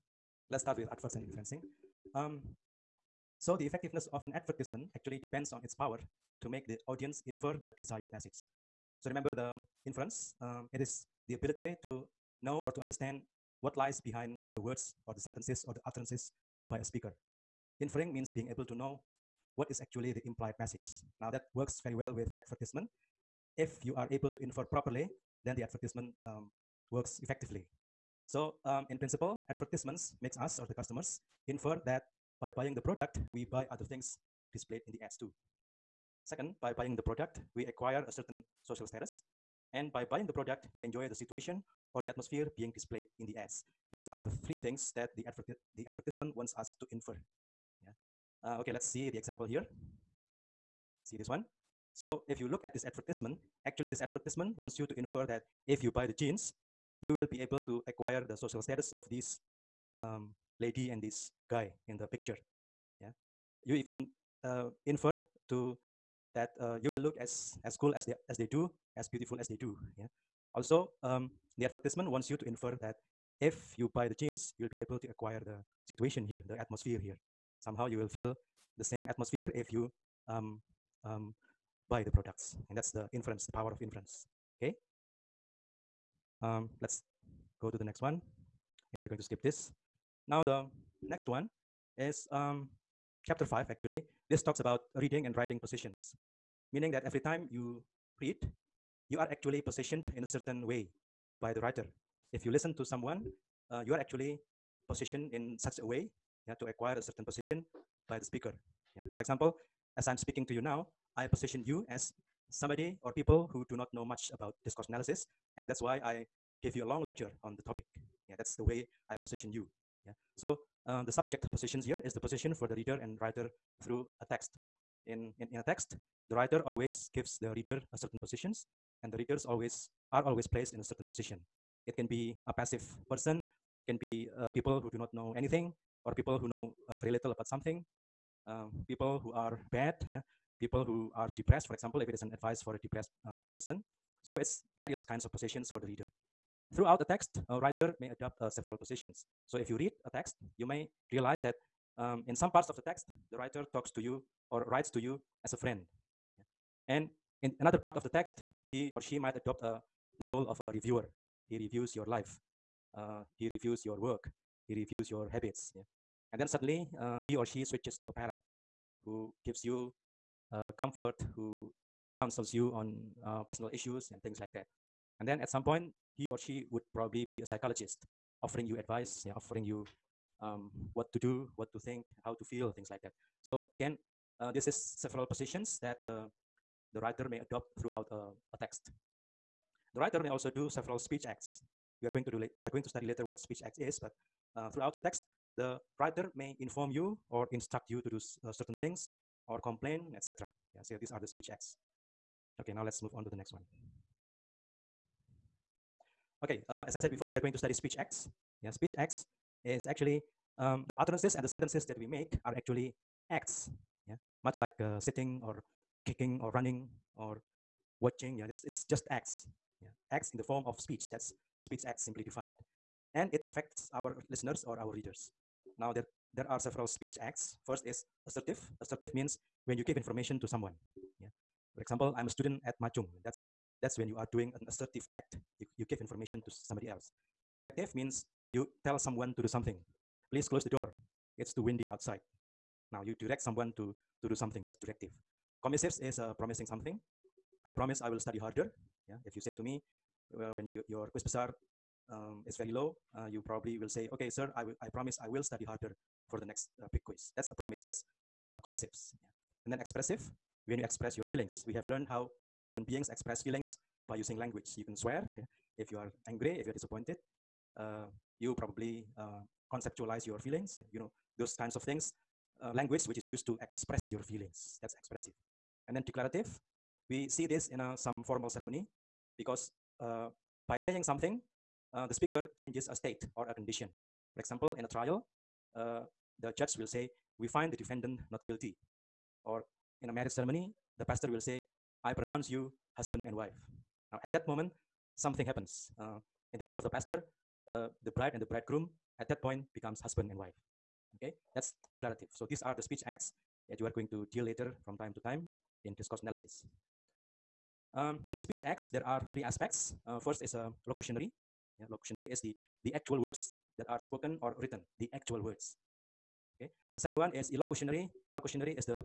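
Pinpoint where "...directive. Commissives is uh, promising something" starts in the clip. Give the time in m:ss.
4:04.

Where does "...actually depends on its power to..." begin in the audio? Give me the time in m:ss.
0:04.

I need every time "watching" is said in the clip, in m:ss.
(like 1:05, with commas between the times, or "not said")
3:38.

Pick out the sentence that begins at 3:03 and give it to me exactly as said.
So again, uh, this is several positions that uh, the writer may adopt throughout a uh, a text.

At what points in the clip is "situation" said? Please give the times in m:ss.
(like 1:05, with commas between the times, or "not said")
0:41, 1:15.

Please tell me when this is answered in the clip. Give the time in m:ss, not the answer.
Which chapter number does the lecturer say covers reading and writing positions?
1:33.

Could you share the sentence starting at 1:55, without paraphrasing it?
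And that's why I give you a long lecture on the topic.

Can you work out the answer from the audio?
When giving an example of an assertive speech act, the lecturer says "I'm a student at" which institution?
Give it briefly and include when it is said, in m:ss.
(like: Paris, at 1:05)
Ma Chung, at 3:52.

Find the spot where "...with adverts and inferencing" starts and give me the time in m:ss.
0:00.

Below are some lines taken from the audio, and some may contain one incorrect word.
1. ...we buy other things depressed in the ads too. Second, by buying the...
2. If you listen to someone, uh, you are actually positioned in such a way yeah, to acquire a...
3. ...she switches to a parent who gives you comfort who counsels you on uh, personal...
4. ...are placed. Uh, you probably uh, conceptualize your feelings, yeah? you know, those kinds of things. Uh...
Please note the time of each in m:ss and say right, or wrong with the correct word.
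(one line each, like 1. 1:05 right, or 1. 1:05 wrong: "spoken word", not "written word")
1. 0:33 wrong: "displayed", not "depressed"
2. 1:42 right
3. 2:47 right
4. 4:26 wrong: "disappointed", not "placed".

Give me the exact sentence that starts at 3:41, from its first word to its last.
That's speech acts simply defined and it affects our listeners or our readers.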